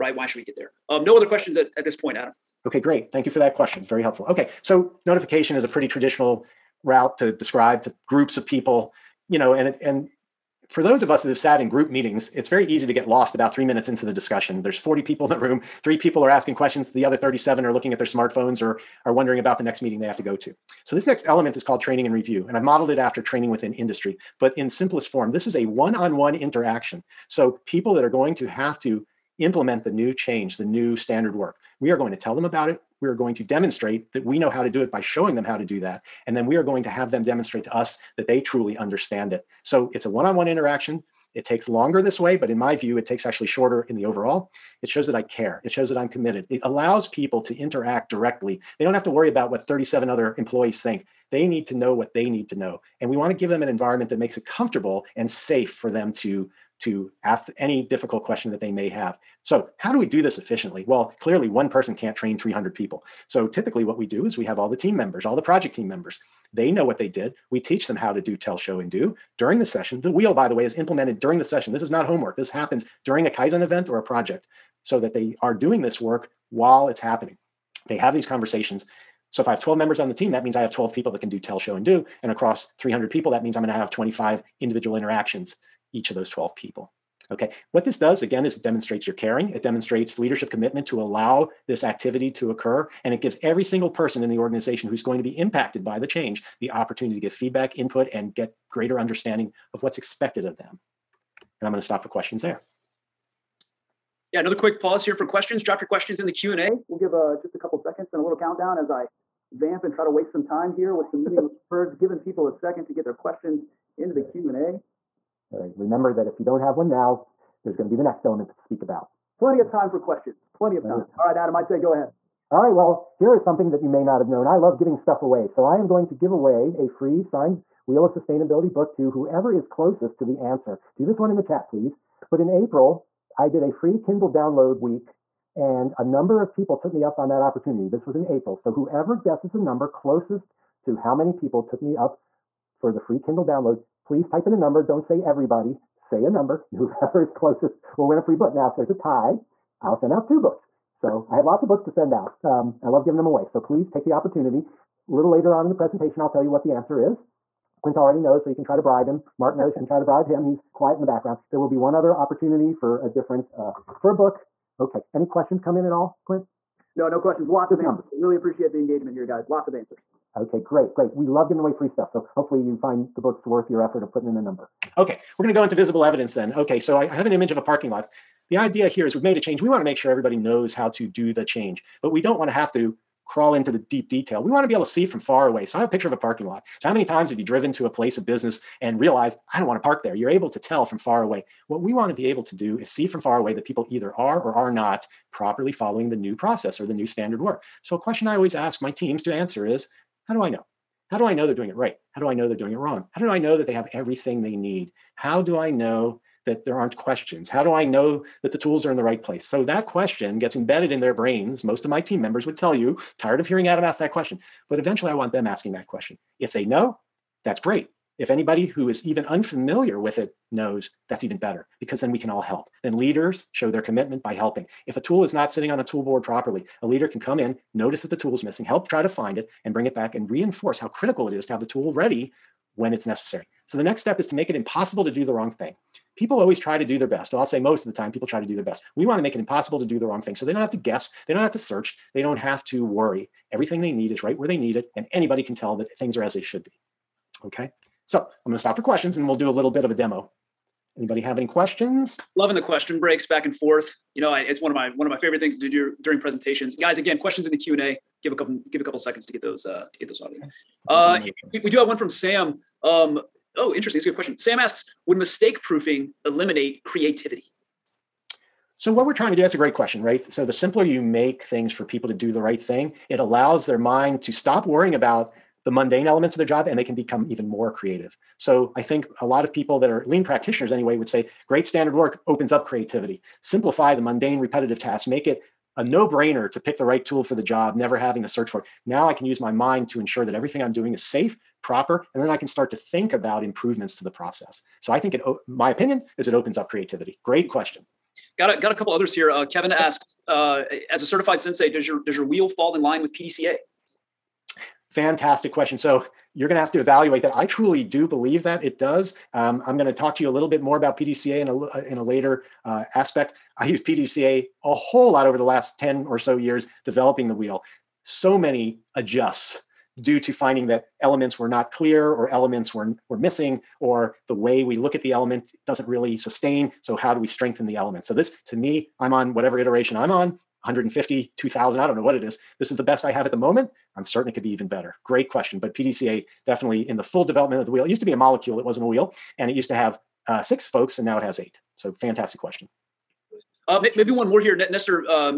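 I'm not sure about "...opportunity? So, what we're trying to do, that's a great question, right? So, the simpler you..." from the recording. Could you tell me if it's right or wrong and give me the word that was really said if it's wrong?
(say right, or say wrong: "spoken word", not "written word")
wrong: "creativity", not "opportunity".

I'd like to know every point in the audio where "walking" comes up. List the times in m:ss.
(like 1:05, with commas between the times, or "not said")
not said.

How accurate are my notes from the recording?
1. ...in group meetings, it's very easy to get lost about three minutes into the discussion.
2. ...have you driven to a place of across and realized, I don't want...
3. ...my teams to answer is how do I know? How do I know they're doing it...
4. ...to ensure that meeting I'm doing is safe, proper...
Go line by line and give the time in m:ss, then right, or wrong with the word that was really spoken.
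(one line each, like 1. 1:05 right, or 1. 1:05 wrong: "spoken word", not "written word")
1. 0:11 right
2. 3:07 wrong: "business", not "across"
3. 3:18 right
4. 4:49 wrong: "everything", not "meeting".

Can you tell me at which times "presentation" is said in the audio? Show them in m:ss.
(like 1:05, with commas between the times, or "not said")
2:35, 4:16.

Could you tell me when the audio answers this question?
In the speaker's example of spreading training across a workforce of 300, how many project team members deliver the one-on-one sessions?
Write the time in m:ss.
1:19.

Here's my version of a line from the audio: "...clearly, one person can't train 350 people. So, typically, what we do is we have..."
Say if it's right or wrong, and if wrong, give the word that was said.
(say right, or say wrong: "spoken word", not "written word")
wrong: "300", not "350".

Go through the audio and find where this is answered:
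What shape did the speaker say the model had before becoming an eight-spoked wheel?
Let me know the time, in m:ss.
5:38.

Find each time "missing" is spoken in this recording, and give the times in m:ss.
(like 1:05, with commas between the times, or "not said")
3:48, 5:23.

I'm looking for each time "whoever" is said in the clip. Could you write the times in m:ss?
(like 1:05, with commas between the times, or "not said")
2:09, 2:18, 2:26.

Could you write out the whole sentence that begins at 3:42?
Then leaders show their commitment by helping.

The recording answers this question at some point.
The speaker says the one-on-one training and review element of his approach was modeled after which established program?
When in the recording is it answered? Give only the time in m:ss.
0:23.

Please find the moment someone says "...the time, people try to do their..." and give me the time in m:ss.
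3:57.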